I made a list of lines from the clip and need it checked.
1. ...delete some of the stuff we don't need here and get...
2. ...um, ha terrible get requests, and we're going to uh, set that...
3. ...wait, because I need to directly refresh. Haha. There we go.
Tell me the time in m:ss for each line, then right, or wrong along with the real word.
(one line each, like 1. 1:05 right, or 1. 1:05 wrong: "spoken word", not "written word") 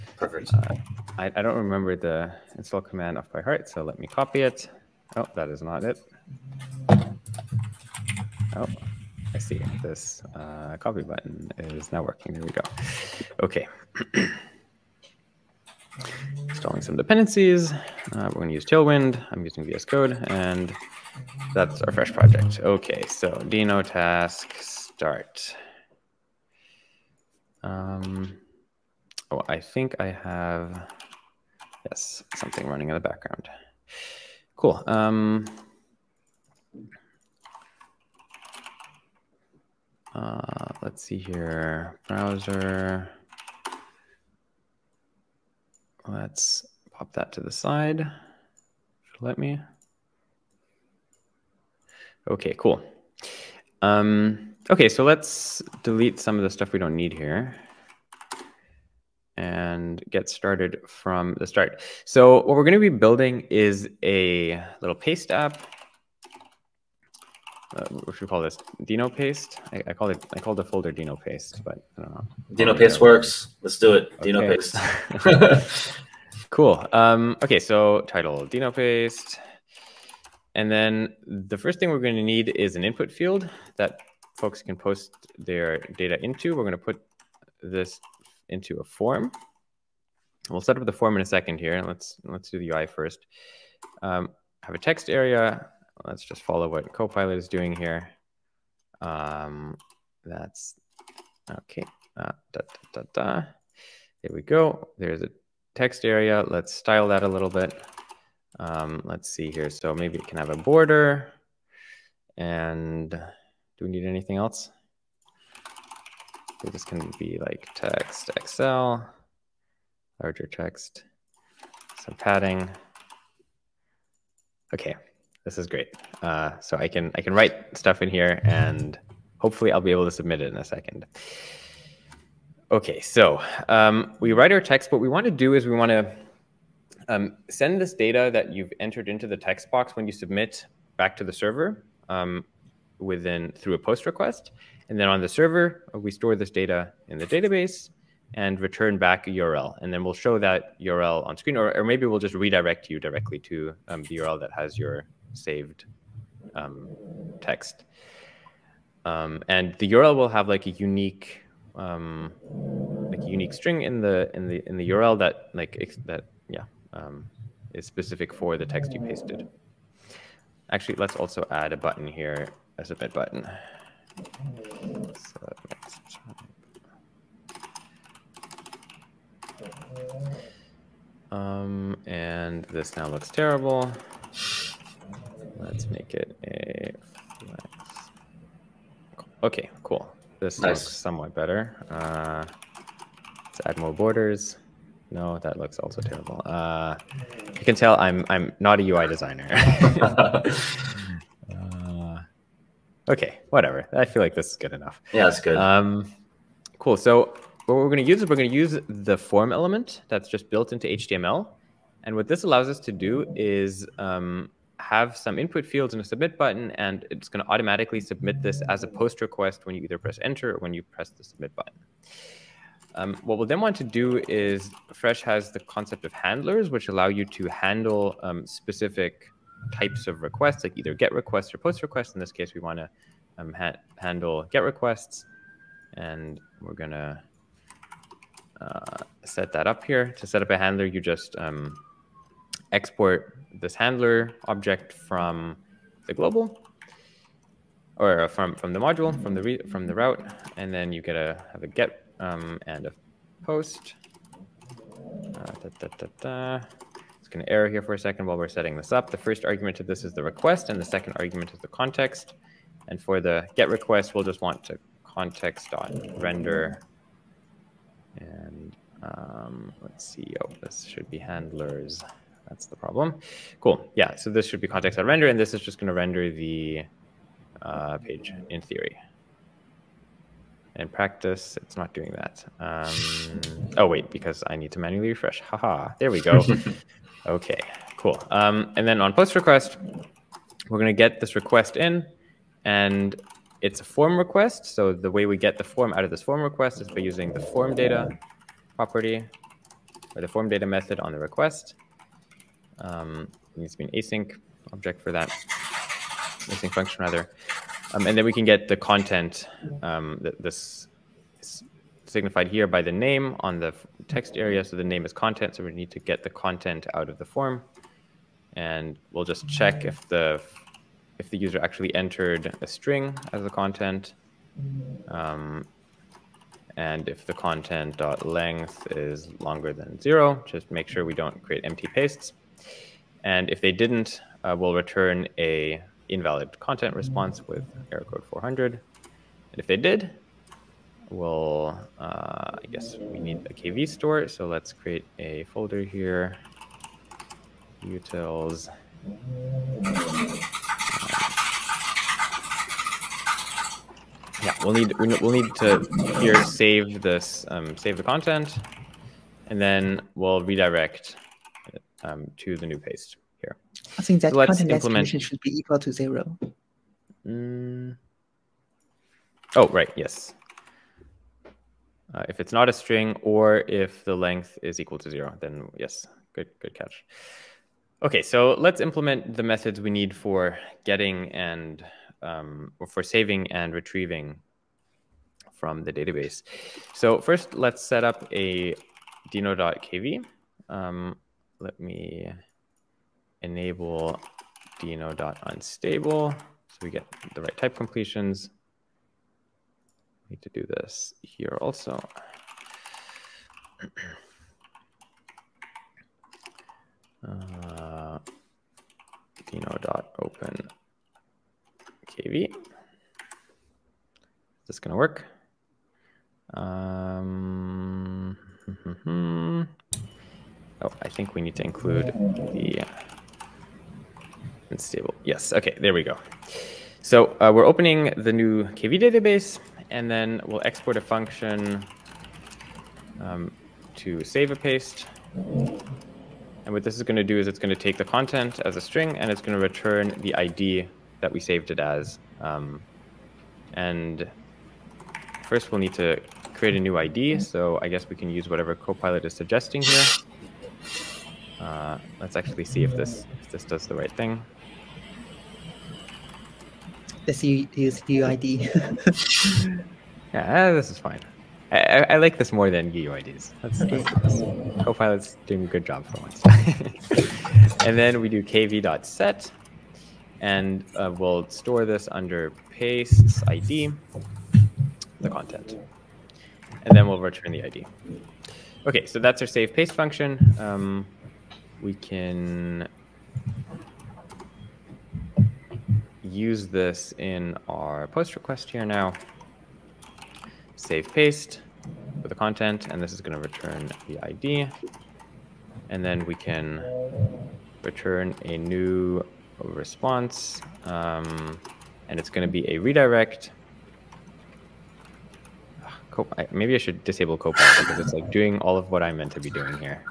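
1. 0:55 right
2. 3:53 wrong: "handle", not "terrible"
3. 4:43 wrong: "manually", not "directly".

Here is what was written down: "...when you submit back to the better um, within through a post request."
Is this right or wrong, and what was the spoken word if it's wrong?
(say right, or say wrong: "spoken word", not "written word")
wrong: "server", not "better".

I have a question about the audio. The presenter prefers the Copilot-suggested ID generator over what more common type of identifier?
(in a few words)
GUIDs.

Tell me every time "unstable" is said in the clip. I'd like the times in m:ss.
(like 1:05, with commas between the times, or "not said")
6:34, 7:04.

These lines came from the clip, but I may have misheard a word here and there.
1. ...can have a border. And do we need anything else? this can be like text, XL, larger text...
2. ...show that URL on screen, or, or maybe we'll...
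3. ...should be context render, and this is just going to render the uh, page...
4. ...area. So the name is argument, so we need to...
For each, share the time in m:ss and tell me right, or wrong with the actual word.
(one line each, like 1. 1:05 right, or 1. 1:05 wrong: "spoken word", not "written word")
1. 1:50 right
2. 2:30 right
3. 4:34 right
4. 5:14 wrong: "content", not "argument".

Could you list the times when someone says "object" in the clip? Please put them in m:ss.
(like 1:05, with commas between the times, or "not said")
4:04, 5:04.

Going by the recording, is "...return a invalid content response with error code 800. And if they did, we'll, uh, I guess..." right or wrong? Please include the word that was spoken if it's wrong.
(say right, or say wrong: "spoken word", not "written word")
wrong: "400", not "800".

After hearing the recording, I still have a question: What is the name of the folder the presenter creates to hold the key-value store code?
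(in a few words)
utils.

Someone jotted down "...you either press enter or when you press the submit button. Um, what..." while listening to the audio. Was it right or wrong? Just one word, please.
right.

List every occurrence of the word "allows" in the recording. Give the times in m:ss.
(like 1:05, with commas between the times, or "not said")
3:32, 3:46.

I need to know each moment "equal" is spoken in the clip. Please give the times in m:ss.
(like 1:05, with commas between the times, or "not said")
6:05, 6:14.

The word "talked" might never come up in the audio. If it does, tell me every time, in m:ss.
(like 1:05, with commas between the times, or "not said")
not said.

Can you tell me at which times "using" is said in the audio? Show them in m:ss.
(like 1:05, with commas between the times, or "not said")
0:19, 4:56.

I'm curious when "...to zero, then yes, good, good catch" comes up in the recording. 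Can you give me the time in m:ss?
6:14.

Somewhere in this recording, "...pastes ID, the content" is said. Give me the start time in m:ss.
7:52.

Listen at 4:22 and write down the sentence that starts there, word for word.
And for the get request, we'll just want to context.render.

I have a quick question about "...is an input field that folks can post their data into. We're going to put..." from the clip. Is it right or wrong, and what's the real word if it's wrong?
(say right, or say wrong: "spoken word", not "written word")
right.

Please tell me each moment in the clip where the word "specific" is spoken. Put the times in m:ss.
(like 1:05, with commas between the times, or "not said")
2:47, 3:48.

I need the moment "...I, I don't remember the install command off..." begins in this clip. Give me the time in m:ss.
0:01.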